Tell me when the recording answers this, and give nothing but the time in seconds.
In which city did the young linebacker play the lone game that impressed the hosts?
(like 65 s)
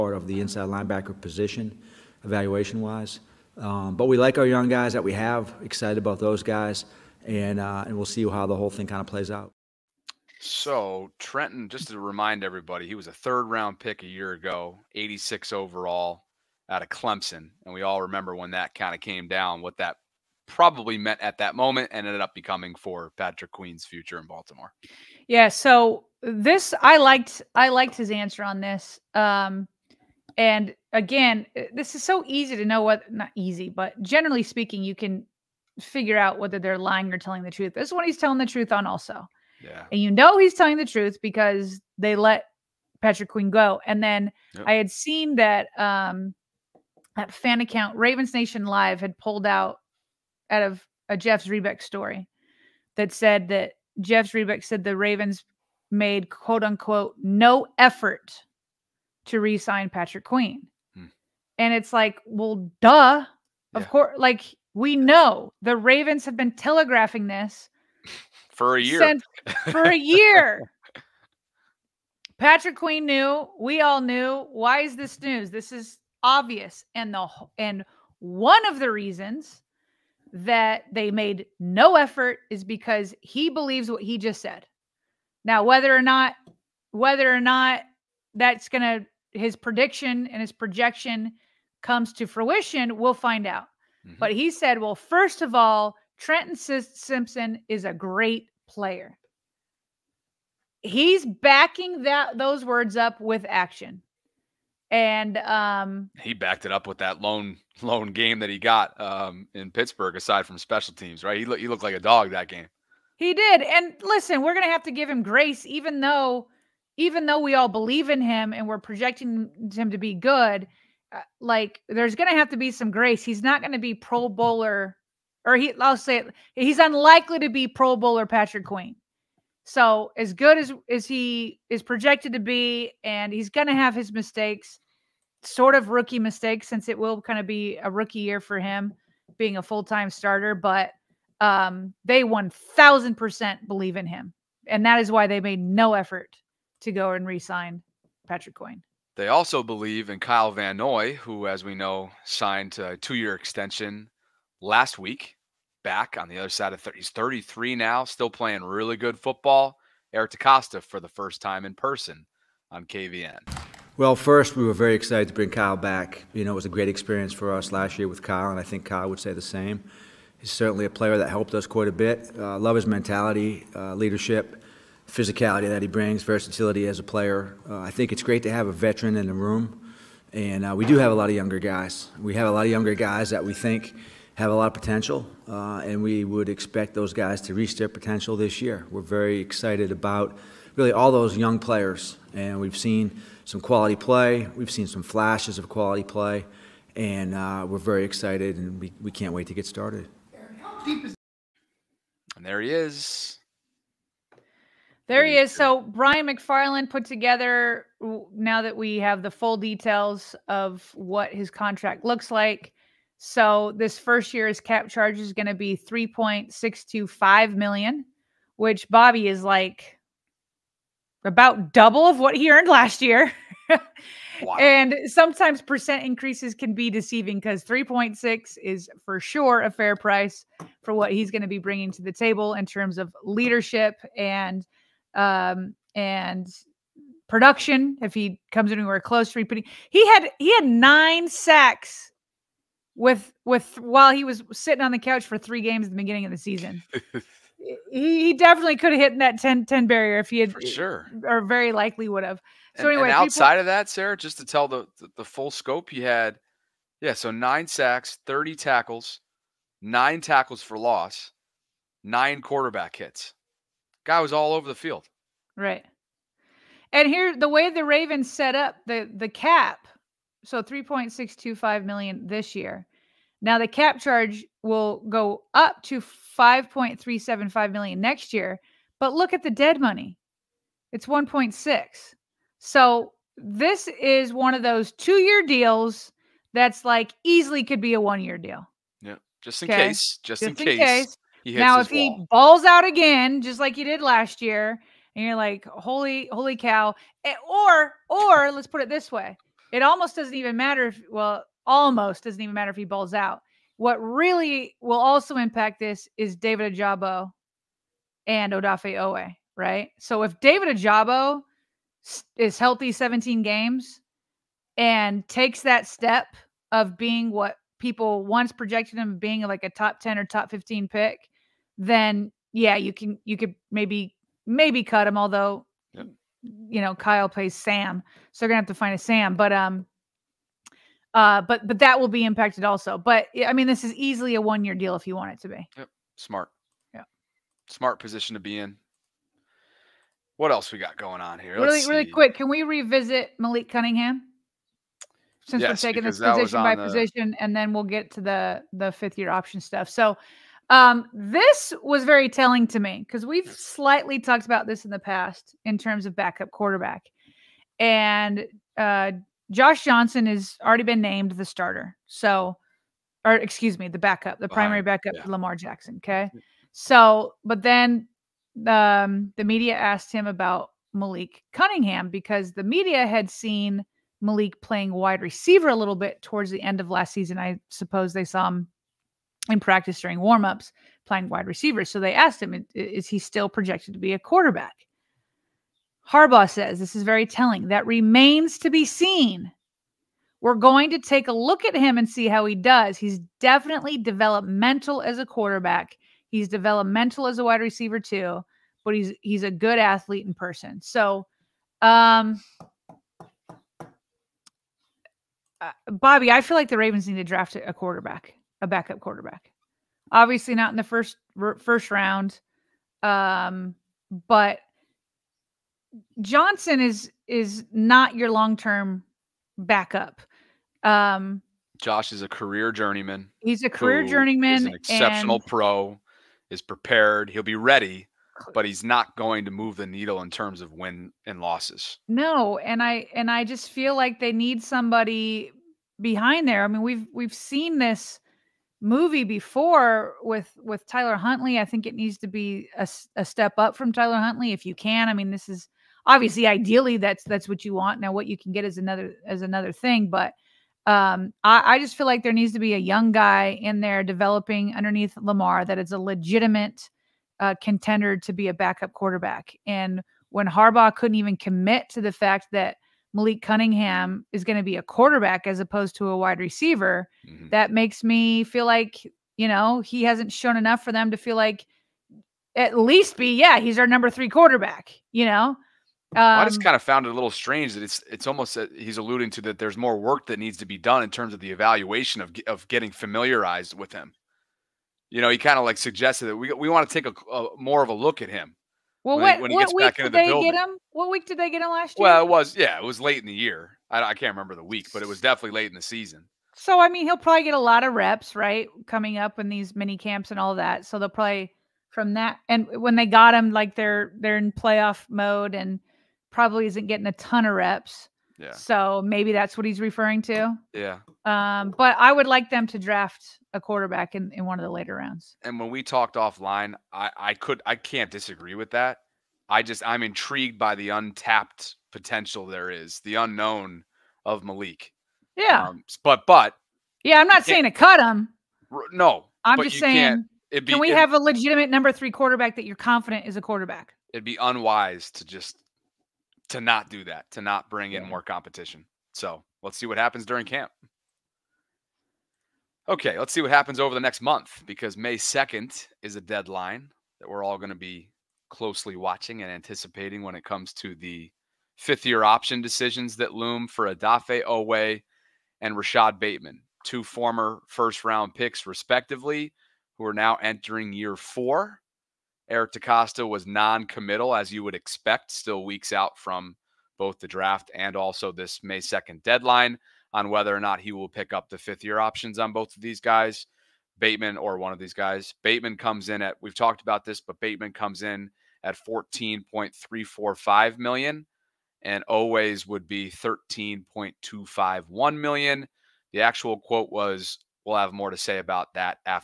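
109 s.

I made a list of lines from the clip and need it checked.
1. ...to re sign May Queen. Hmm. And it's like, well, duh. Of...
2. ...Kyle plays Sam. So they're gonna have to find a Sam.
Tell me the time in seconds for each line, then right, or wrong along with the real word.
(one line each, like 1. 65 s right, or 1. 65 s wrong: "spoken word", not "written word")
1. 59 s wrong: "Patrick", not "May"
2. 326 s right.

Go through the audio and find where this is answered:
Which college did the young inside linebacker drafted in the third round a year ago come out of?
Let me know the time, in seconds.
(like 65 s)
16 s.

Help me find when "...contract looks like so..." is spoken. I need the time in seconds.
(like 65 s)
211 s.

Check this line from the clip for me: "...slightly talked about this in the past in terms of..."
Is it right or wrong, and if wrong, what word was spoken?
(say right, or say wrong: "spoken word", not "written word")
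right.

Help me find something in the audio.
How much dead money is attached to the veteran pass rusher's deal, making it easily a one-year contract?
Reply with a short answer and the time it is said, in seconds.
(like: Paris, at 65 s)
1.6 million, at 281 s.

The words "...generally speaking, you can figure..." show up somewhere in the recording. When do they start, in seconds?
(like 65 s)
34 s.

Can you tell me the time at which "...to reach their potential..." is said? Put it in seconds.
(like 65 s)
187 s.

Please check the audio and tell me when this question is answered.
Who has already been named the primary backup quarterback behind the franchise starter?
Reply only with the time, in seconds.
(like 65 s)
359 s.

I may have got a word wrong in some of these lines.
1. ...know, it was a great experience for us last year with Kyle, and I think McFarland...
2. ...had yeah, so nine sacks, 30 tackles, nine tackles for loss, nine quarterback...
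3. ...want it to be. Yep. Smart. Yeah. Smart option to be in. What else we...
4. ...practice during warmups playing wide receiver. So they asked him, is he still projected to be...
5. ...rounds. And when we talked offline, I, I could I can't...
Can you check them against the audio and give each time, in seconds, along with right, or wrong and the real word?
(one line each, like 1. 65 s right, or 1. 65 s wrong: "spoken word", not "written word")
1. 166 s wrong: "Kyle", not "McFarland"
2. 256 s right
3. 335 s wrong: "position", not "option"
4. 379 s right
5. 514 s right.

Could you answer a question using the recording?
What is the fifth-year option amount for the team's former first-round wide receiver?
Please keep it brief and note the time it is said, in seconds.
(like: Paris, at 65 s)
$14.345 million, at 578 s.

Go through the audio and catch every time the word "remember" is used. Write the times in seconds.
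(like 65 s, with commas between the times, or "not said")
18 s, 494 s.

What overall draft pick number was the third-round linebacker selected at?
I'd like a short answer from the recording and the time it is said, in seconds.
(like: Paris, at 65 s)
86, at 14 s.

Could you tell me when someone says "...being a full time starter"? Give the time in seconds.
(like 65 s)
139 s.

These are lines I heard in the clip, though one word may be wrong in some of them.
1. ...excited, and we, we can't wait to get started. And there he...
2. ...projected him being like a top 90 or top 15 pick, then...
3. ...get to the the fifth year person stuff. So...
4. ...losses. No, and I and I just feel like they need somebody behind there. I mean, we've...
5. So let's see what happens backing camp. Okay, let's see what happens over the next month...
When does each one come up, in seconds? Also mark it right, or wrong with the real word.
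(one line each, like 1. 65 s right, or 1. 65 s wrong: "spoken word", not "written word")
1. 198 s right
2. 318 s wrong: "10", not "90"
3. 347 s wrong: "option", not "person"
4. 431 s right
5. 539 s wrong: "during", not "backing".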